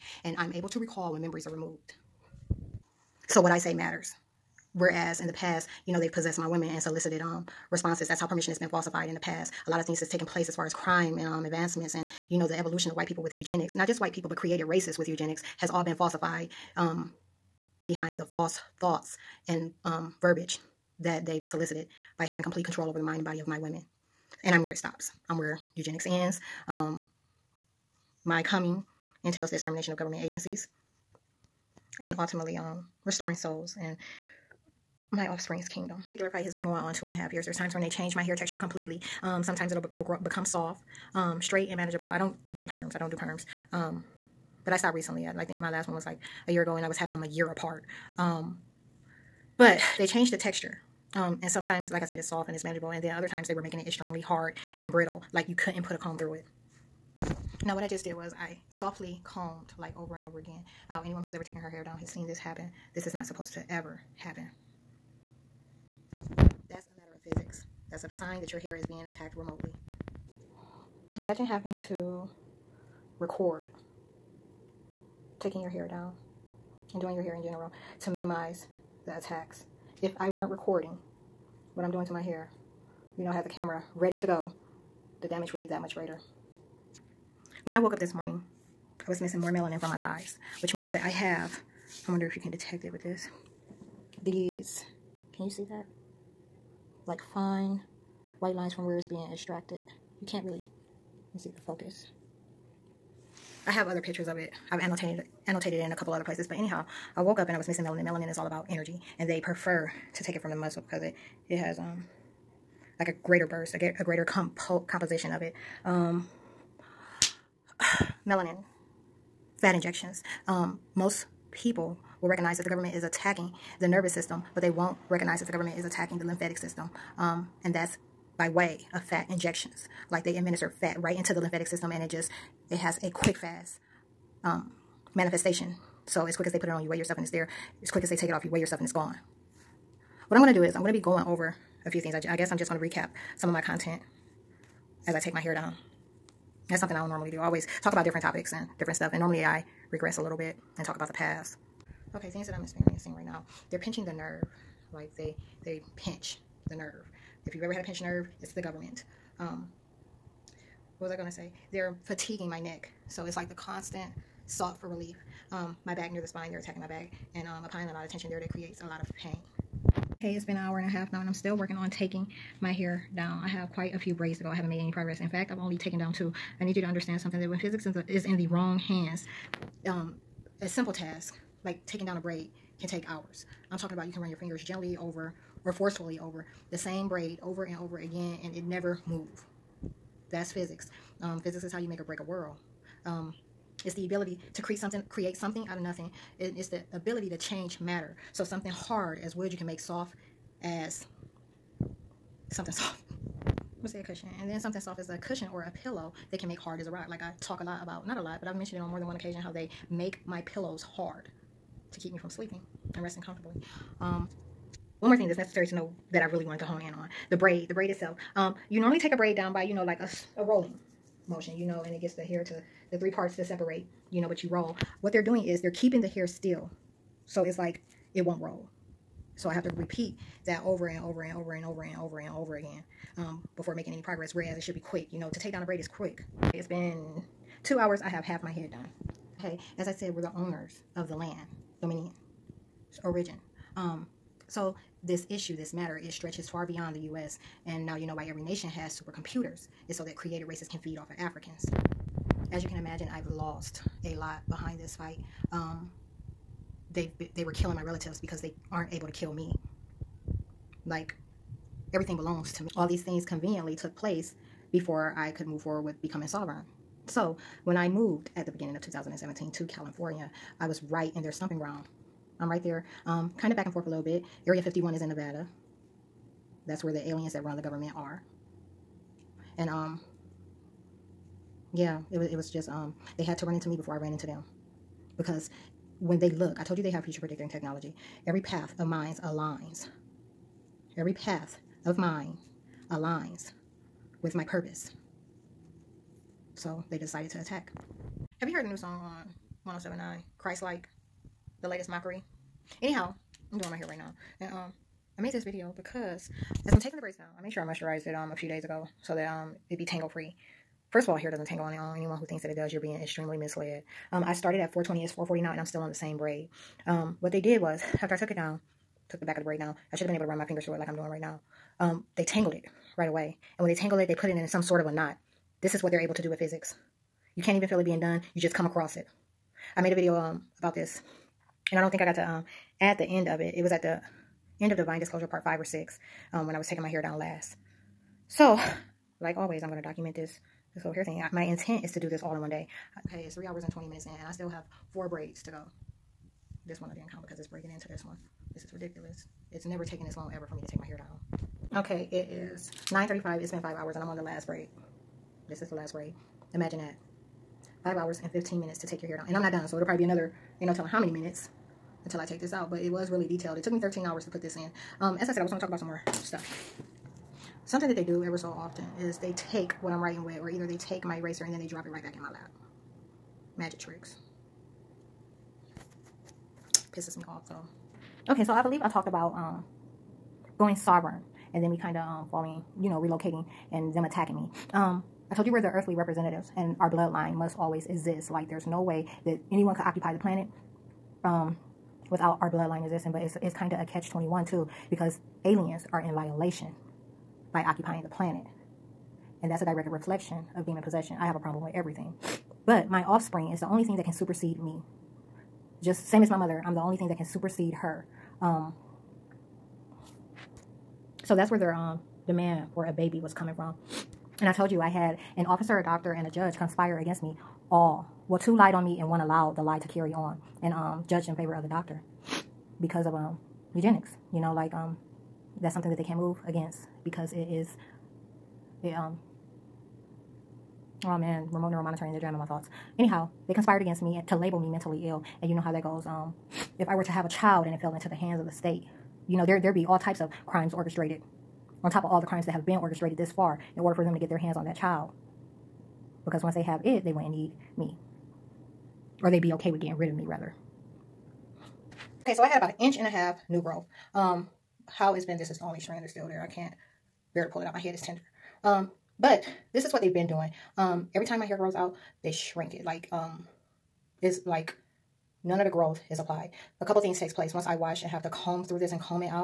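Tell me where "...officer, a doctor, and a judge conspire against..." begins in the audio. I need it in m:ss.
6:55.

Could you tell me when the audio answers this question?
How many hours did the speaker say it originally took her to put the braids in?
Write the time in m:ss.
6:03.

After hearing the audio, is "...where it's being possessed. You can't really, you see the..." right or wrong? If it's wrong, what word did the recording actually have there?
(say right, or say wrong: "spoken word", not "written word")
wrong: "extracted", not "possessed".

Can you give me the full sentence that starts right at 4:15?
Um, they they were killing my relatives because they aren't able to kill me.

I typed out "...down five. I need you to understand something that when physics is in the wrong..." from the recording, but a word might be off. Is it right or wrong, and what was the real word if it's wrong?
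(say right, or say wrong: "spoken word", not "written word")
wrong: "two", not "five".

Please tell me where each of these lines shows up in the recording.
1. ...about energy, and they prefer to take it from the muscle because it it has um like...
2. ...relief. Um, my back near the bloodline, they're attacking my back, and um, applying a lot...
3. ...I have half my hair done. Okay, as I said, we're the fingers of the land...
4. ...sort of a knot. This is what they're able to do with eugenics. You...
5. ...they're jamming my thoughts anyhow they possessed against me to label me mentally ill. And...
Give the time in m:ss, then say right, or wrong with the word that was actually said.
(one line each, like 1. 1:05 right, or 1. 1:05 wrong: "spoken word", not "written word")
1. 1:48 right
2. 2:44 wrong: "spine", not "bloodline"
3. 3:58 wrong: "owners", not "fingers"
4. 5:24 wrong: "physics", not "eugenics"
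5. 7:12 wrong: "conspired", not "possessed".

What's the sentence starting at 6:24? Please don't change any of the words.
Um, I told you we're the earthly representatives, and our bloodline must always exist.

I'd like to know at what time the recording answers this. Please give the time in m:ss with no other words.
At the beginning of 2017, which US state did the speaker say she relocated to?
4:29.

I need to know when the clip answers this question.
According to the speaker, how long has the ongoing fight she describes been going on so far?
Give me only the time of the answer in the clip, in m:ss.
0:36.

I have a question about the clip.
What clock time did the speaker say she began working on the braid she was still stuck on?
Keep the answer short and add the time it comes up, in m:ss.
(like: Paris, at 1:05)
4:20, at 5:14.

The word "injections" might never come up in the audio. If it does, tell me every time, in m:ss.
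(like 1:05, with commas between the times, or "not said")
1:59, 2:09.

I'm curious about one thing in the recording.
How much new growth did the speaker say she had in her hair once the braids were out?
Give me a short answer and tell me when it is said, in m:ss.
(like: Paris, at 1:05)
an inch and a half, at 7:32.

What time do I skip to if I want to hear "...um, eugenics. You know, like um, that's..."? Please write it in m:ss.
7:03.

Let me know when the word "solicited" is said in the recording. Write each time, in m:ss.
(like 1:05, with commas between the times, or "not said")
0:06, 0:21.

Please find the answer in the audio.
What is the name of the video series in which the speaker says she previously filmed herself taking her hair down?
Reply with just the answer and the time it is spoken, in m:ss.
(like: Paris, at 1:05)
Divine Disclosure, at 5:34.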